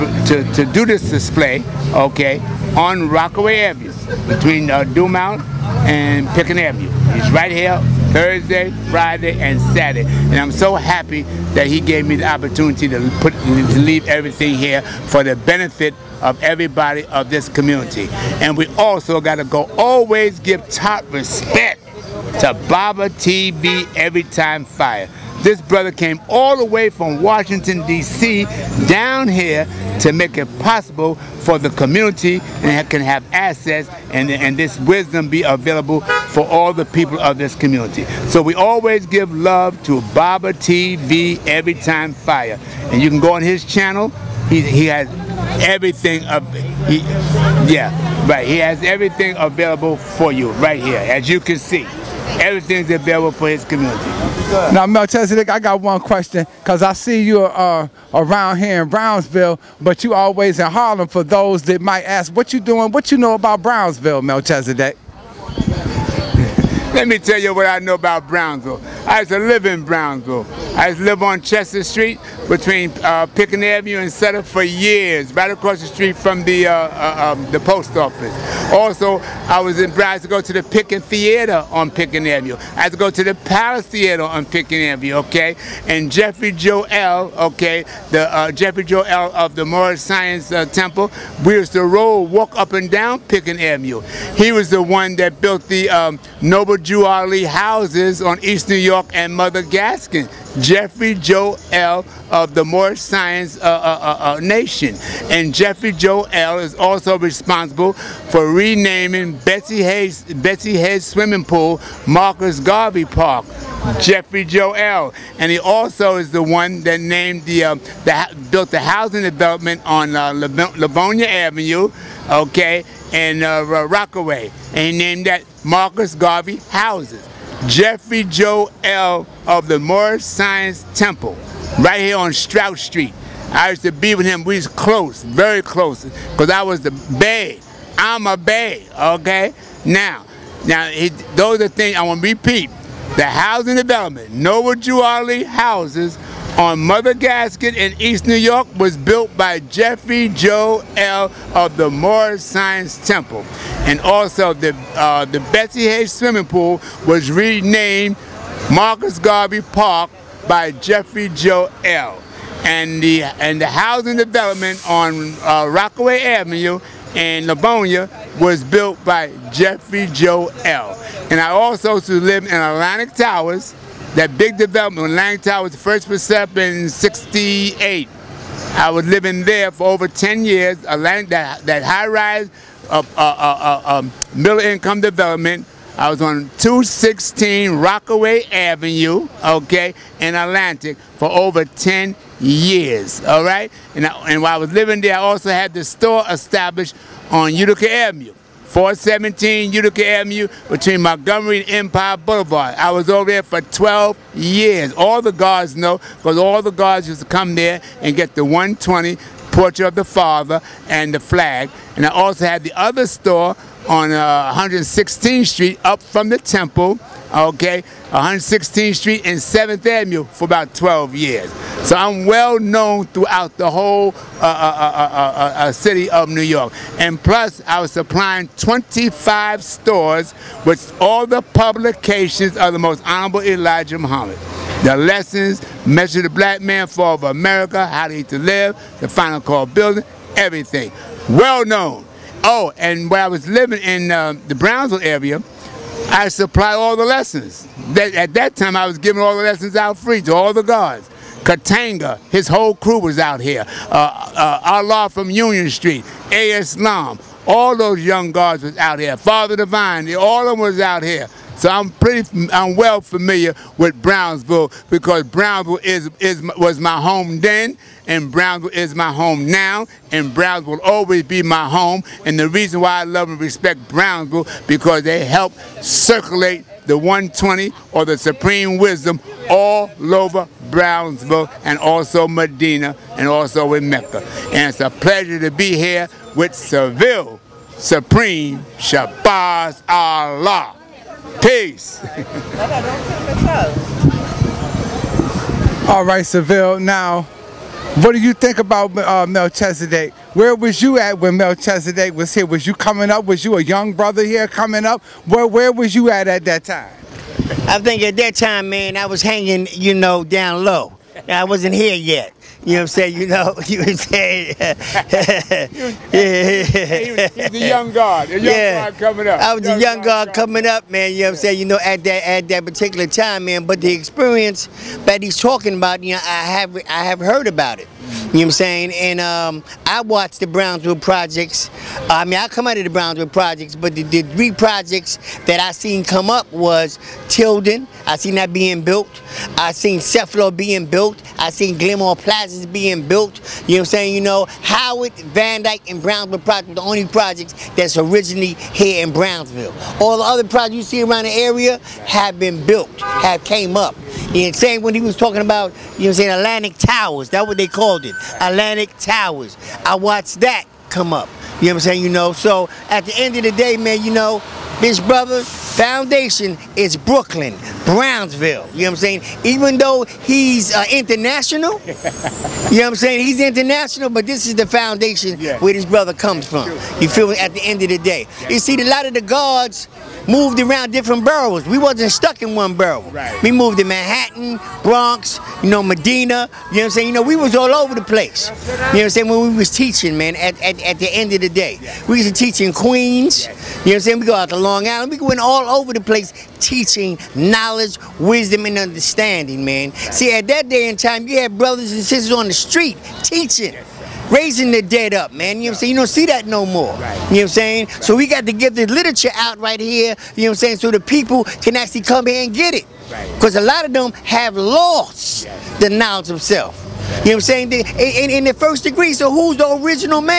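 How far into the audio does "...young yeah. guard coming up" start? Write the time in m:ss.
5:18.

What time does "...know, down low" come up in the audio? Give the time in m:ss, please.
5:09.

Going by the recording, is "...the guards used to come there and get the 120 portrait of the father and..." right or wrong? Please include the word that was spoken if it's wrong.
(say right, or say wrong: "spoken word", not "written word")
right.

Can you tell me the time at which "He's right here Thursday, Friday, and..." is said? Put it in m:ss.
0:07.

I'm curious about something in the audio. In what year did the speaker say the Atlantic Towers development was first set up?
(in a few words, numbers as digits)
1968.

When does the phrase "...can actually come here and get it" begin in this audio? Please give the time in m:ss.
6:51.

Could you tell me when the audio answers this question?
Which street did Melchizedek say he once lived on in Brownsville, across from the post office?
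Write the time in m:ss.
1:11.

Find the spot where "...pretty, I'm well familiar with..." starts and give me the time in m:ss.
4:21.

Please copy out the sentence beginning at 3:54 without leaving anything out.
The lessons, Measure the Black Man, Fall of America, How to Eat to Live, The Final Call Building, everything.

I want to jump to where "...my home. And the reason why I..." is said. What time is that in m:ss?
4:31.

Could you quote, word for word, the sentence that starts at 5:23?
But the experience that he's talking about, you know, I have I have heard about it.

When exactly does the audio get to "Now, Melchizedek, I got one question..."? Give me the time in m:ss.
0:54.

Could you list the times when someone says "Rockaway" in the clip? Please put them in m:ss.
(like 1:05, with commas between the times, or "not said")
0:03, 2:03, 2:45, 3:07.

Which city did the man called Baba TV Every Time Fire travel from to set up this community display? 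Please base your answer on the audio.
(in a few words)
Washington, D.C.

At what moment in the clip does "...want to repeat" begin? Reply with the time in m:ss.
2:22.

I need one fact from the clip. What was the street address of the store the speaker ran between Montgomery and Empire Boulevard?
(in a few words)
417 Utica Avenue.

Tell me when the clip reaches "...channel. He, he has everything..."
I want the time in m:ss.
0:43.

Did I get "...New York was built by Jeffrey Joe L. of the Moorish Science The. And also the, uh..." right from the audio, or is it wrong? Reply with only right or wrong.
wrong.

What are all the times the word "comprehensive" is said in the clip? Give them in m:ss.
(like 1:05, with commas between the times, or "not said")
not said.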